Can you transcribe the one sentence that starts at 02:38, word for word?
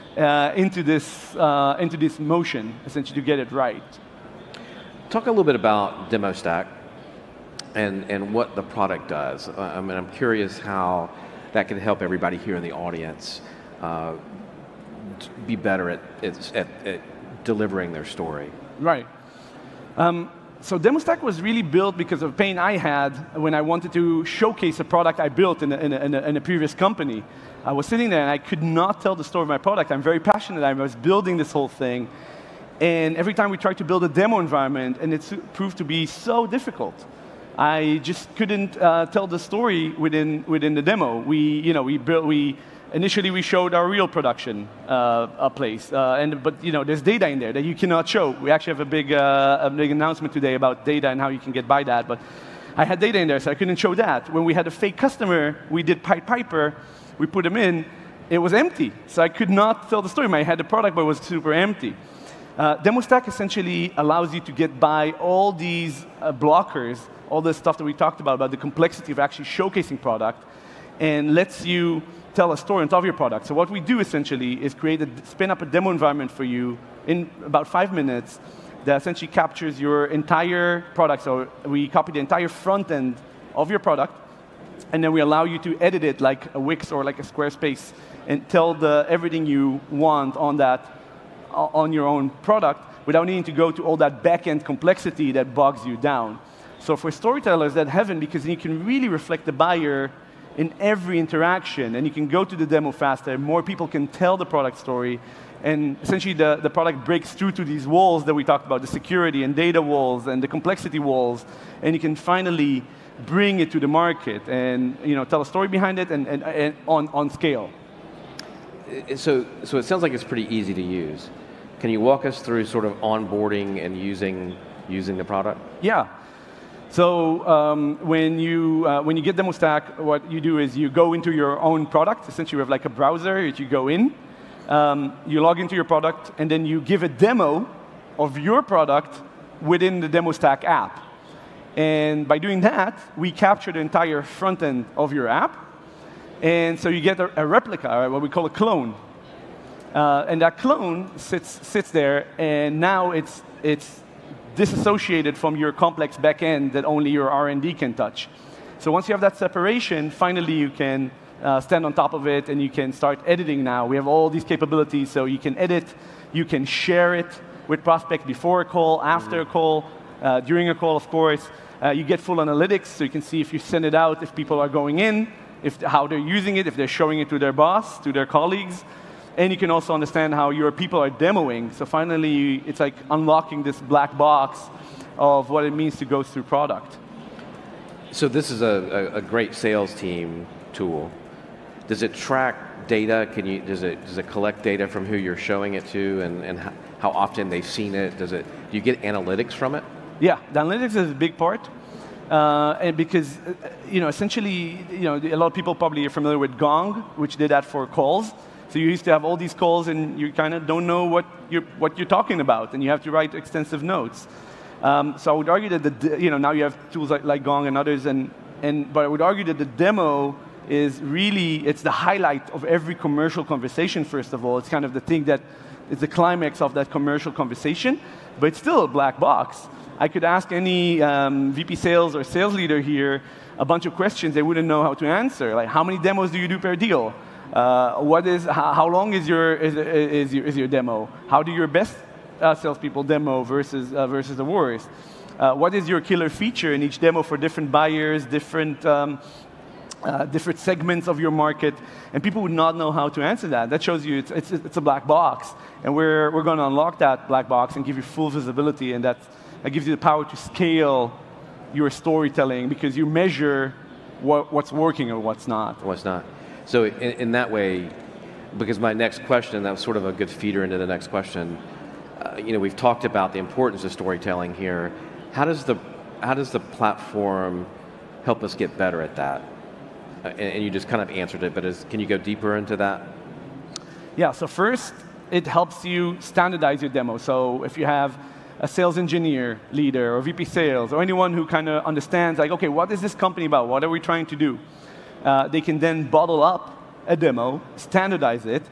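So once you have that separation, finally you can uh, stand on top of it and you can start editing now.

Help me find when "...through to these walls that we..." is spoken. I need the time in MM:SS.
01:47.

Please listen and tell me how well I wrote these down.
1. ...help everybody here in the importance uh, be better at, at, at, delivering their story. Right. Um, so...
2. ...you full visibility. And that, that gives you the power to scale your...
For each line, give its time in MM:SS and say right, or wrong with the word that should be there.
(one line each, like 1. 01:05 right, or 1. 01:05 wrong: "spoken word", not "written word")
1. 00:11 wrong: "audience", not "importance"
2. 04:17 right.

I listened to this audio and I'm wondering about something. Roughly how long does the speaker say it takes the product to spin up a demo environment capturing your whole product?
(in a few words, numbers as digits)
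5 minutes.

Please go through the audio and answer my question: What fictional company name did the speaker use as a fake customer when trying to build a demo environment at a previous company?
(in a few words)
Pied Piper.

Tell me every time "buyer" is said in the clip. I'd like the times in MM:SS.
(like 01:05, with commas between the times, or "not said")
01:39, 04:07.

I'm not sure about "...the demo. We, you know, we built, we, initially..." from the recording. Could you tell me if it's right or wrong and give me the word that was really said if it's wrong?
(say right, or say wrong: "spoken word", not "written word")
right.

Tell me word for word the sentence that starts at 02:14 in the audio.
Um, you log into your product, and then you give a demo of your product within the DemoStack app.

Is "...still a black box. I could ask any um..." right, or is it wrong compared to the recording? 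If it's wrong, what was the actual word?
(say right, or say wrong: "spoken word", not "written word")
right.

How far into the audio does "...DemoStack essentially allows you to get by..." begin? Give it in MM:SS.
01:02.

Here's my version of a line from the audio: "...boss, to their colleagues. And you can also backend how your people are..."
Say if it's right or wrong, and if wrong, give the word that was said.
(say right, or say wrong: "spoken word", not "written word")
wrong: "understand", not "backend".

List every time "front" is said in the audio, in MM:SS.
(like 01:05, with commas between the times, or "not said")
01:22, 02:24.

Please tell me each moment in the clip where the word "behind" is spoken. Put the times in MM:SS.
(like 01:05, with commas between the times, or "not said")
01:55.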